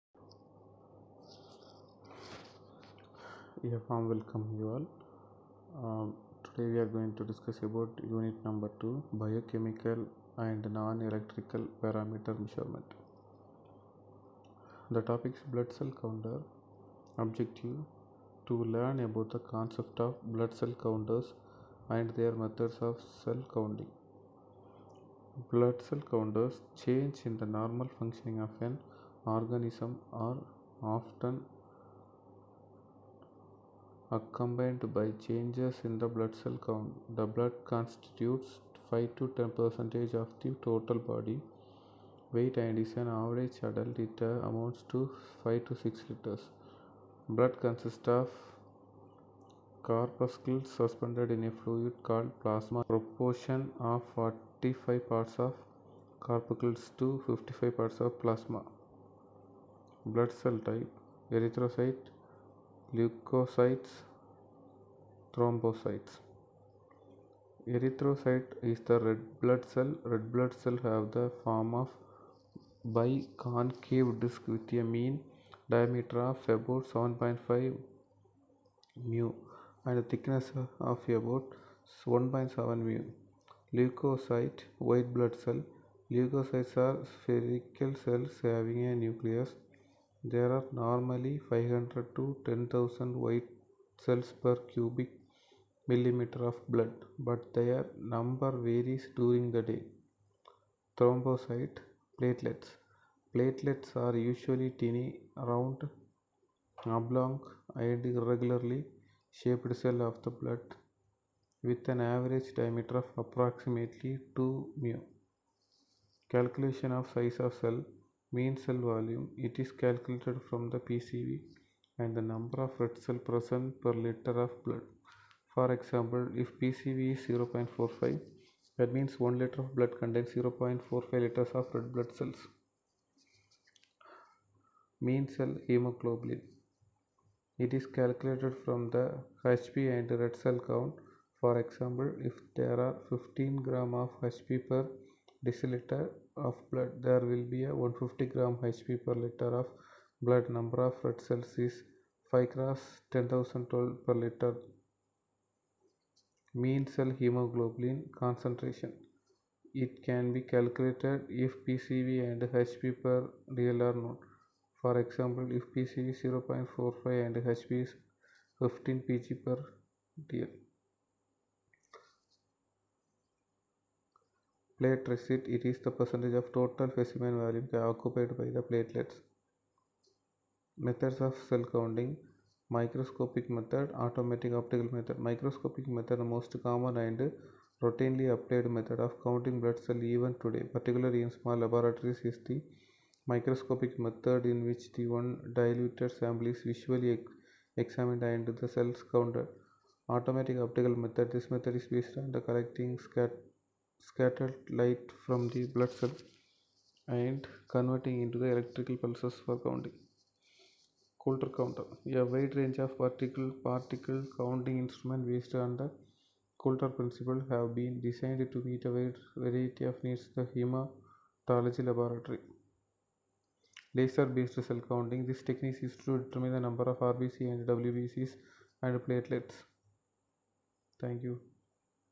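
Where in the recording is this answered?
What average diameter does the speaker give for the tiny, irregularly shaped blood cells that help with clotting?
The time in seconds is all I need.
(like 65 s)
114 s.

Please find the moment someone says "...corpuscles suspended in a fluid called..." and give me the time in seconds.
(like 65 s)
49 s.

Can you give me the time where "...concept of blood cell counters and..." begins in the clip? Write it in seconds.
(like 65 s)
19 s.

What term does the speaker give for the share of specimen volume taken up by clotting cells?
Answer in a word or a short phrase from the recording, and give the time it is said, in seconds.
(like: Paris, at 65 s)
Platelet rate, at 174 s.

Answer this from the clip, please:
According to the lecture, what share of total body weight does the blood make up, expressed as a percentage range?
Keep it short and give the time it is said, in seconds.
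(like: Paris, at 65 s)
5 to 10 percent, at 38 s.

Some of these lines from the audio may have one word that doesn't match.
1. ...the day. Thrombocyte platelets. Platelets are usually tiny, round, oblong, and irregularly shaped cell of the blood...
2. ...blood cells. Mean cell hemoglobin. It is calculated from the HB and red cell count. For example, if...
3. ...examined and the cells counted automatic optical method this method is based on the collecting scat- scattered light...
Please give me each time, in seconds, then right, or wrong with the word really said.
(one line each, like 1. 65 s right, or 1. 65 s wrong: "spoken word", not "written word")
1. 99 s right
2. 131 s right
3. 197 s right.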